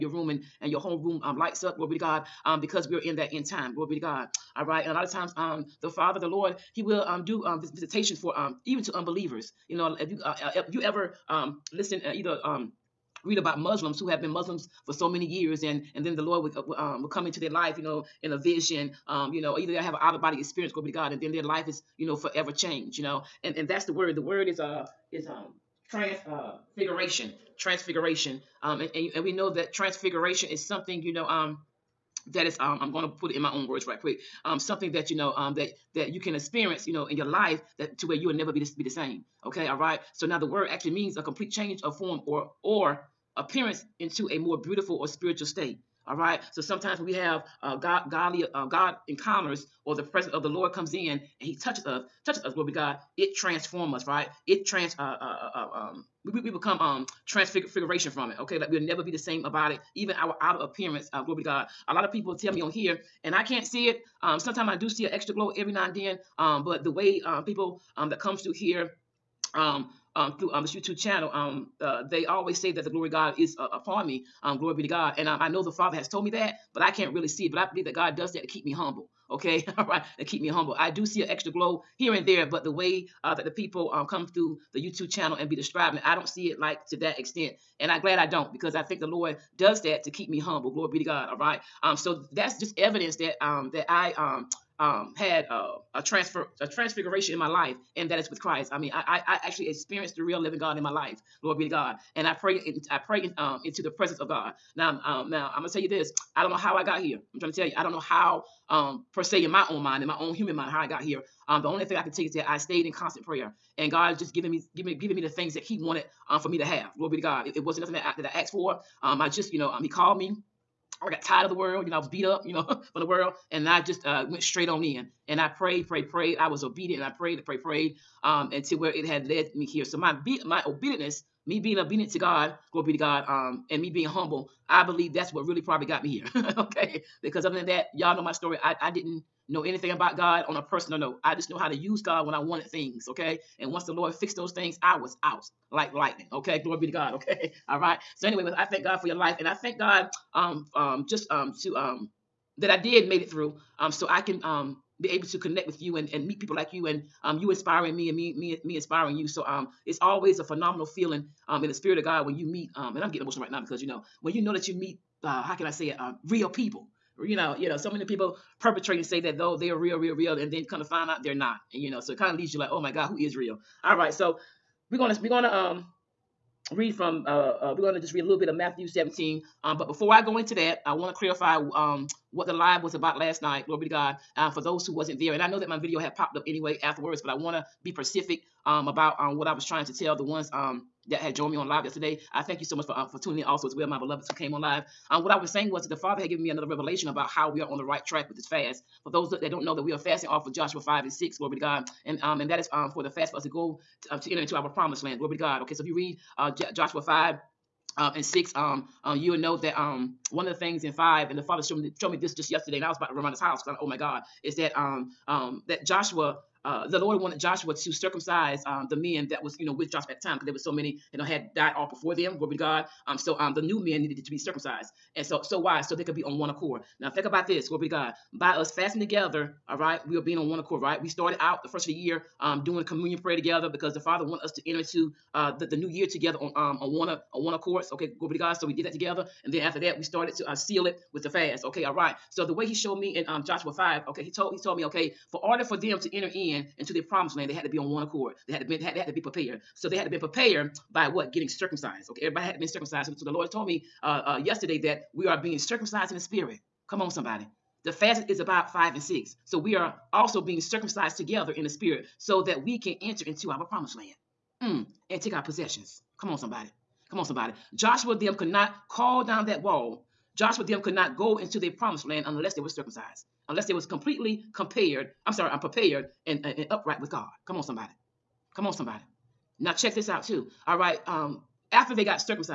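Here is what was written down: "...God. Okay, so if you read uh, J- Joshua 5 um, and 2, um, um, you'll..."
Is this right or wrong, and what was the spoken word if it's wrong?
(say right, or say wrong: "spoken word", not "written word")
wrong: "6", not "2".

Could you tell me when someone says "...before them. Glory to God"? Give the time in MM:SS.
03:41.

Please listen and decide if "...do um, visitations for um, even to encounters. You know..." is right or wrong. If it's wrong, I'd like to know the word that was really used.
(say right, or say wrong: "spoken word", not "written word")
wrong: "unbelievers", not "encounters".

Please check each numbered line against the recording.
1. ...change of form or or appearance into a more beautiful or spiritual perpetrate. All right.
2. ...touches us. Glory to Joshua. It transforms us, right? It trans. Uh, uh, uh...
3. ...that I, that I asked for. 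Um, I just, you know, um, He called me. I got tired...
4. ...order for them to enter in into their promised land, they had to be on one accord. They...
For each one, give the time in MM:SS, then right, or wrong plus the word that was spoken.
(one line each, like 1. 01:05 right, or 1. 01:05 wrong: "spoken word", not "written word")
1. 00:41 wrong: "state", not "perpetrate"
2. 00:52 wrong: "God", not "Joshua"
3. 01:57 right
4. 04:05 right.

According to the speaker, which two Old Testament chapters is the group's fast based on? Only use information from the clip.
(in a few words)
Joshua 5 and 6.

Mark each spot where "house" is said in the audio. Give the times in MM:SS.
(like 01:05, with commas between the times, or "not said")
03:33.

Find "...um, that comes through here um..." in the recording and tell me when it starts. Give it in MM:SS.
01:07.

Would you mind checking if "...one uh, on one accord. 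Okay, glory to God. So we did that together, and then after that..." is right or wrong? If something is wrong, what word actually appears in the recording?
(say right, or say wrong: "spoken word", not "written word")
right.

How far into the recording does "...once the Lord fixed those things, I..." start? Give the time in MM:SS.
02:23.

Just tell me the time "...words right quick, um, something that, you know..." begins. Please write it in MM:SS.
00:33.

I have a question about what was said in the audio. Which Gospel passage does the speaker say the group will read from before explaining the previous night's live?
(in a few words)
Matthew 17.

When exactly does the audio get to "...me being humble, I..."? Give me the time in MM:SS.
02:13.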